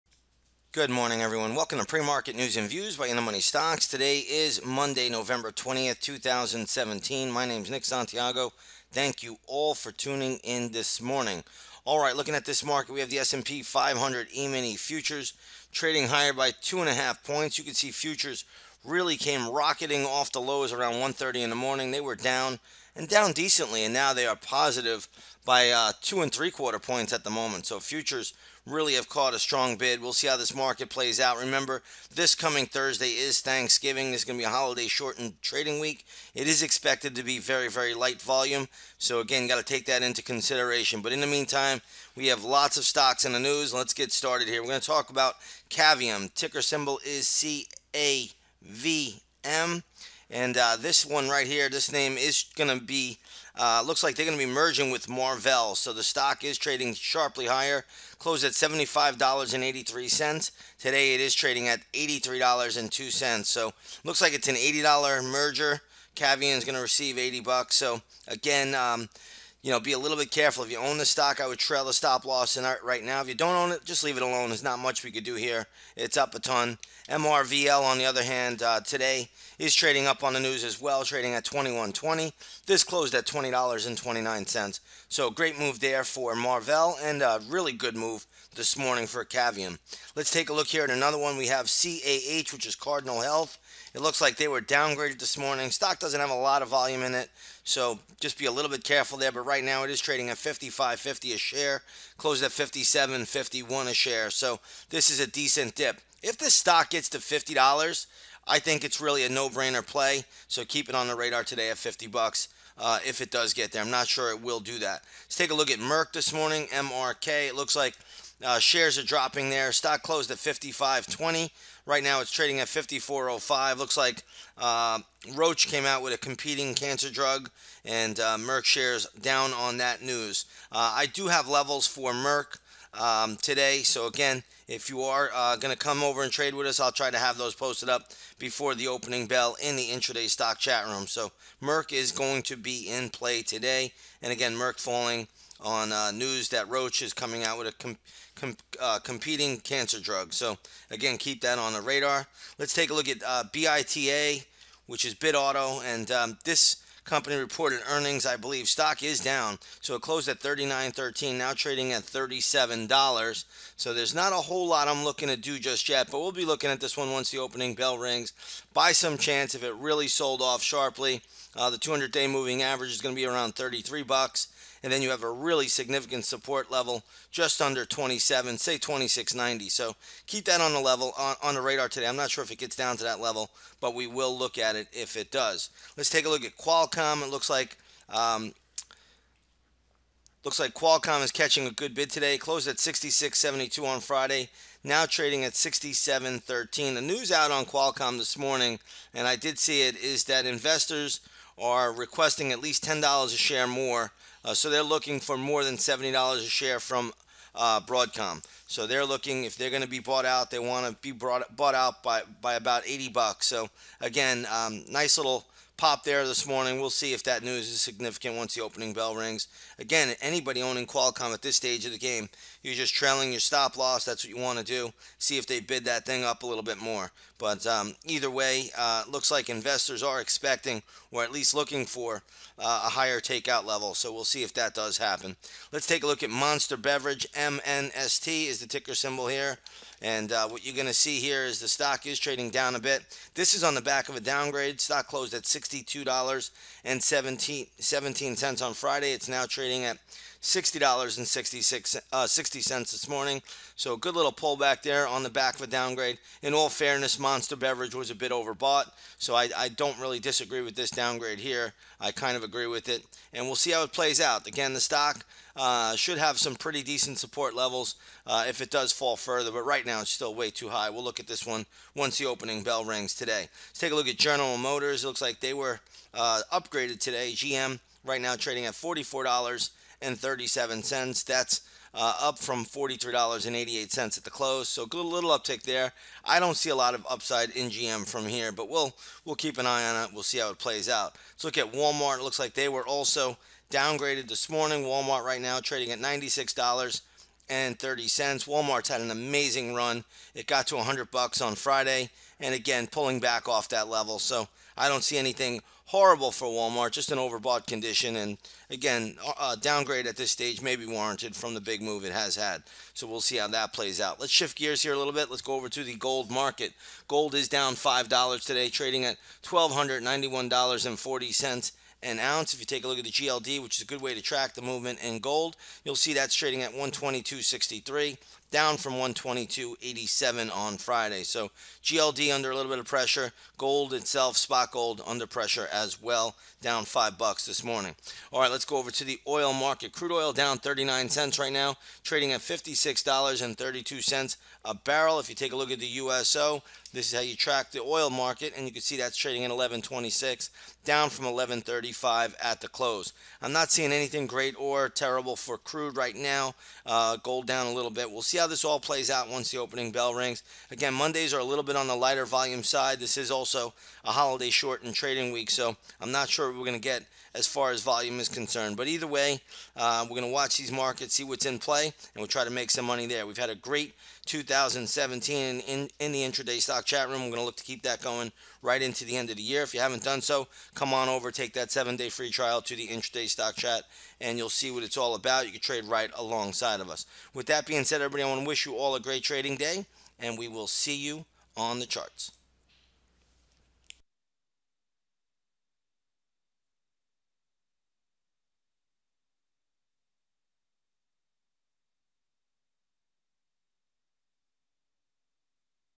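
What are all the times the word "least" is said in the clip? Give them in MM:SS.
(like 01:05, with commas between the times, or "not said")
03:22, 03:51.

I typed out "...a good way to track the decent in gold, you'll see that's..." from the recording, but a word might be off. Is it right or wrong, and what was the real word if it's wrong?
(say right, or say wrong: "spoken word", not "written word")
wrong: "movement", not "decent".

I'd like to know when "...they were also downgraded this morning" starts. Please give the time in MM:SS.
04:52.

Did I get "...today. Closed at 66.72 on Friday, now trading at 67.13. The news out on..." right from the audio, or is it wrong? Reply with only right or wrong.
right.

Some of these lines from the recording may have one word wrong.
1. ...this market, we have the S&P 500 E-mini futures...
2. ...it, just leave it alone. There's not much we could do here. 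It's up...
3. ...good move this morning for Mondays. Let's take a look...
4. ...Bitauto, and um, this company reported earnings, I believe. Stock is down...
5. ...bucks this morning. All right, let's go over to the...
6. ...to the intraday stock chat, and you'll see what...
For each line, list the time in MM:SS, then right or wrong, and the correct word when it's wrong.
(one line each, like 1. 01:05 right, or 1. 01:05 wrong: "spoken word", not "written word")
1. 00:12 right
2. 01:13 right
3. 01:27 wrong: "Cavium", not "Mondays"
4. 02:35 right
5. 05:37 right
6. 06:22 right.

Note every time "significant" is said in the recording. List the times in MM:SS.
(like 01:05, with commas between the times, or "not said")
02:55, 03:37.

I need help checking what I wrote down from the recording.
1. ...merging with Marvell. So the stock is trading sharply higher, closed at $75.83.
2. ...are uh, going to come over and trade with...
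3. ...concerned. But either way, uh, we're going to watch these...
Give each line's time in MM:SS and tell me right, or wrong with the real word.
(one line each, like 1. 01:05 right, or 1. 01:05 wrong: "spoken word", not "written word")
1. 00:54 right
2. 02:15 right
3. 06:08 right.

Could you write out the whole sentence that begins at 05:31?
So GLD under a little bit of pressure.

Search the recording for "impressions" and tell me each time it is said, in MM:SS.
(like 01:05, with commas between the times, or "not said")
not said.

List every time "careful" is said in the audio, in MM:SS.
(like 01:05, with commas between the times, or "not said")
01:10, 01:38.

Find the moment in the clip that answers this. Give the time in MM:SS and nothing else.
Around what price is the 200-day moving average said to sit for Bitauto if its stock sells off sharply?
02:53.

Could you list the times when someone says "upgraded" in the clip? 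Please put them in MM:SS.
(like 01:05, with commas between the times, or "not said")
04:36.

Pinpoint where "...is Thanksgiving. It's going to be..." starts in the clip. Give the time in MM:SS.
00:33.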